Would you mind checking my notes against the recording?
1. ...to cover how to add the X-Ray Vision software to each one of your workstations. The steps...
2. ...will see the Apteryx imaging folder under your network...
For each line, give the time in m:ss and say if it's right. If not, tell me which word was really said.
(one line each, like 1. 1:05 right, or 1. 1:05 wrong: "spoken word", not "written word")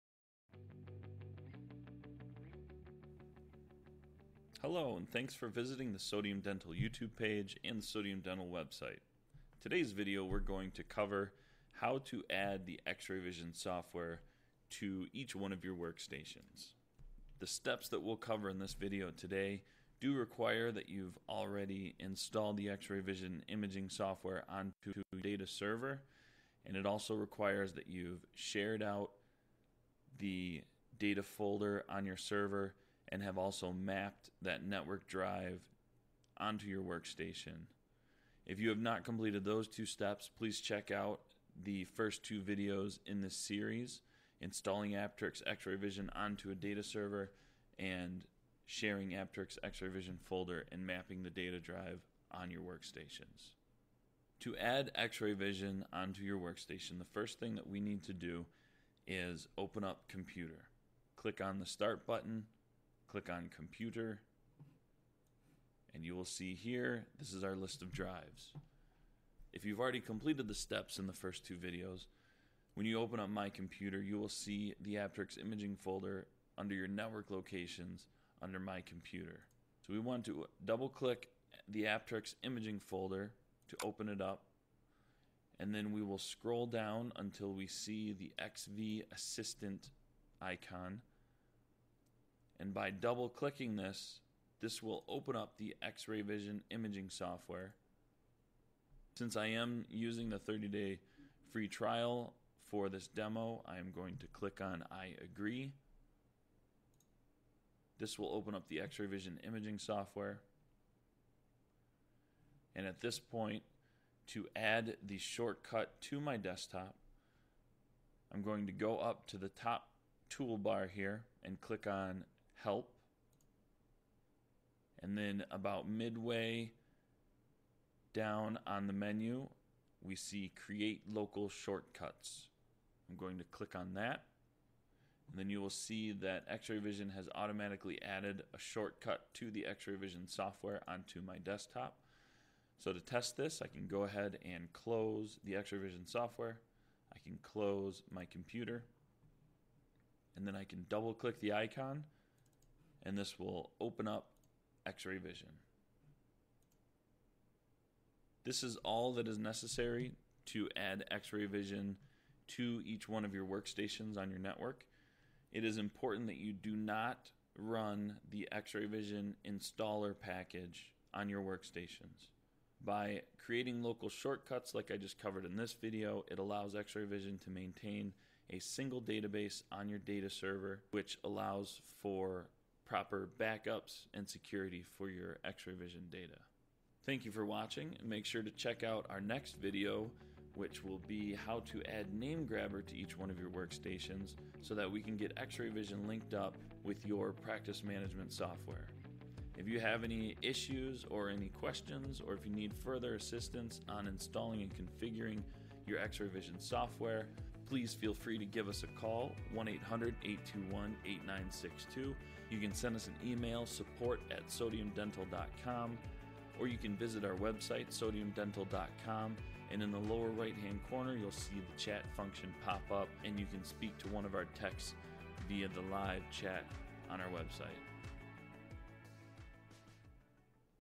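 1. 0:10 right
2. 1:14 right.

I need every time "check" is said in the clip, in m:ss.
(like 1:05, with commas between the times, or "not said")
0:40, 3:08.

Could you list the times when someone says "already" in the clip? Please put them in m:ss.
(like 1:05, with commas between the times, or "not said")
0:21, 1:09.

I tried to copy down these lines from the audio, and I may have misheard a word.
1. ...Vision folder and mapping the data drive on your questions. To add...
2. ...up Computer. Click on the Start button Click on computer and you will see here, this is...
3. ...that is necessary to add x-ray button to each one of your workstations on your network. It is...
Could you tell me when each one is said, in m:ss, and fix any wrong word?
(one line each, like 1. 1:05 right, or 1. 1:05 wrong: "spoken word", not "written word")
1. 0:49 wrong: "workstations", not "questions"
2. 0:59 right
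3. 2:39 wrong: "vision", not "button".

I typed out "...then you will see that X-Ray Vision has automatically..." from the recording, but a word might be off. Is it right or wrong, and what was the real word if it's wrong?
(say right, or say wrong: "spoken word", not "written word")
right.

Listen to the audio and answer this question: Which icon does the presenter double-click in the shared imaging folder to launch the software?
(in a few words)
XV Assistant.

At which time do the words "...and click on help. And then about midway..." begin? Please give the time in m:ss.
2:01.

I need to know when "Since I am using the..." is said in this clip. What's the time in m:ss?
1:39.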